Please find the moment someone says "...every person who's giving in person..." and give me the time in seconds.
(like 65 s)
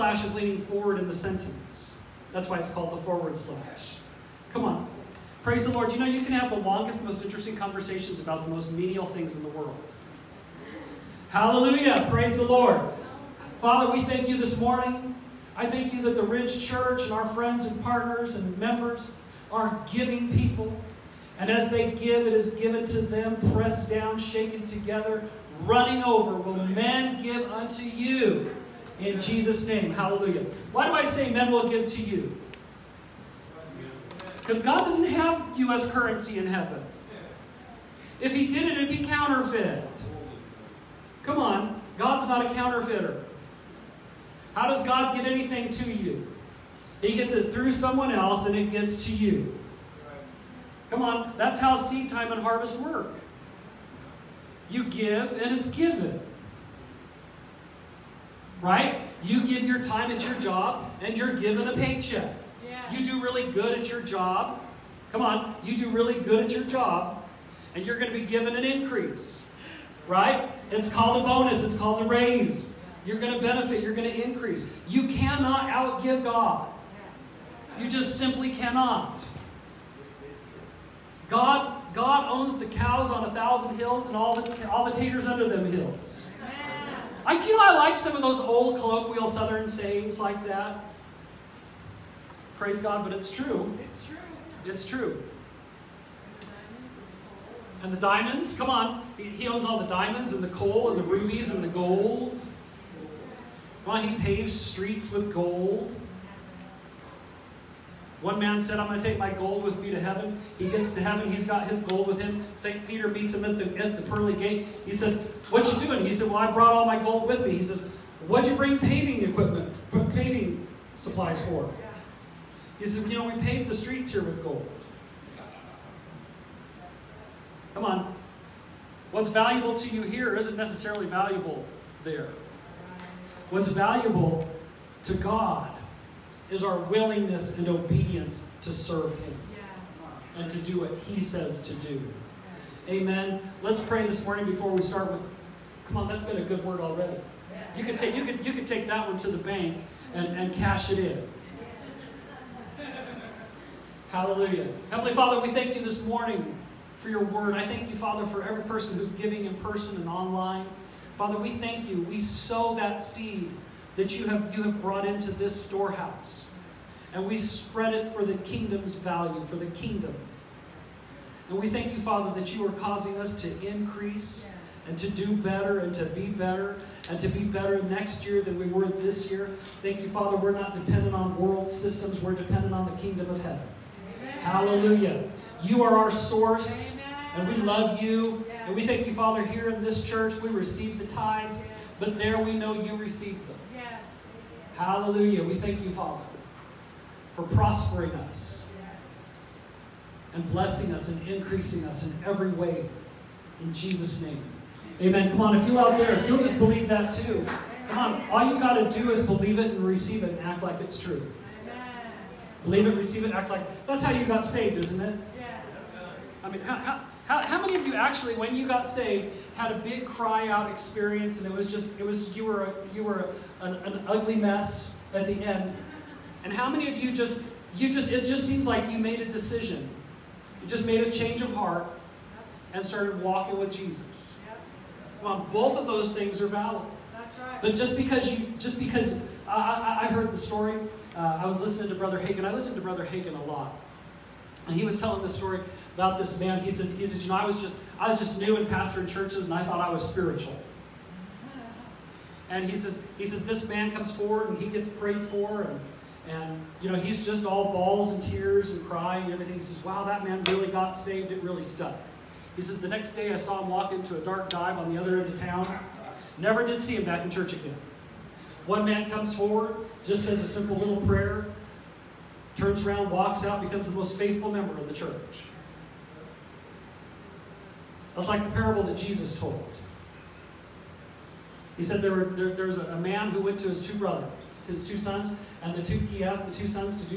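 158 s.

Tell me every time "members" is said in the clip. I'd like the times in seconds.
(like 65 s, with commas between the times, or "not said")
18 s, 274 s.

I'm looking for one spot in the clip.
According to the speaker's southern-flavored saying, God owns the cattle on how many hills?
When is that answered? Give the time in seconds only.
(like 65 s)
83 s.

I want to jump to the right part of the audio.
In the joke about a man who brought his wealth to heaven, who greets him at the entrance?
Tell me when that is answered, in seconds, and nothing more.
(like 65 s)
112 s.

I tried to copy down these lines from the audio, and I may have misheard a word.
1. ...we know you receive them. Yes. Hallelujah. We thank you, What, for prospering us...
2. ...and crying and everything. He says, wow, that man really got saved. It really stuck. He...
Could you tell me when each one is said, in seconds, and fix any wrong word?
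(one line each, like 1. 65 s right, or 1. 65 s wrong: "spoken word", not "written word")
1. 192 s wrong: "Father", not "What"
2. 258 s right.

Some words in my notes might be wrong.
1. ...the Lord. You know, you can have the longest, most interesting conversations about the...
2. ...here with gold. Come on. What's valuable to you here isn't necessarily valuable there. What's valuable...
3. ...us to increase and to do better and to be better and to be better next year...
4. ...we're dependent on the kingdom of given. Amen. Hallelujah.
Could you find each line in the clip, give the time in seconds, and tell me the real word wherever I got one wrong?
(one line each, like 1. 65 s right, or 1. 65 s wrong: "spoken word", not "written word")
1. 5 s right
2. 124 s right
3. 173 s right
4. 182 s wrong: "heaven", not "given".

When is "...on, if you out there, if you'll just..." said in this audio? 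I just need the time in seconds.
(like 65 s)
205 s.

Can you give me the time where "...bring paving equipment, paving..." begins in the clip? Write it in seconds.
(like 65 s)
118 s.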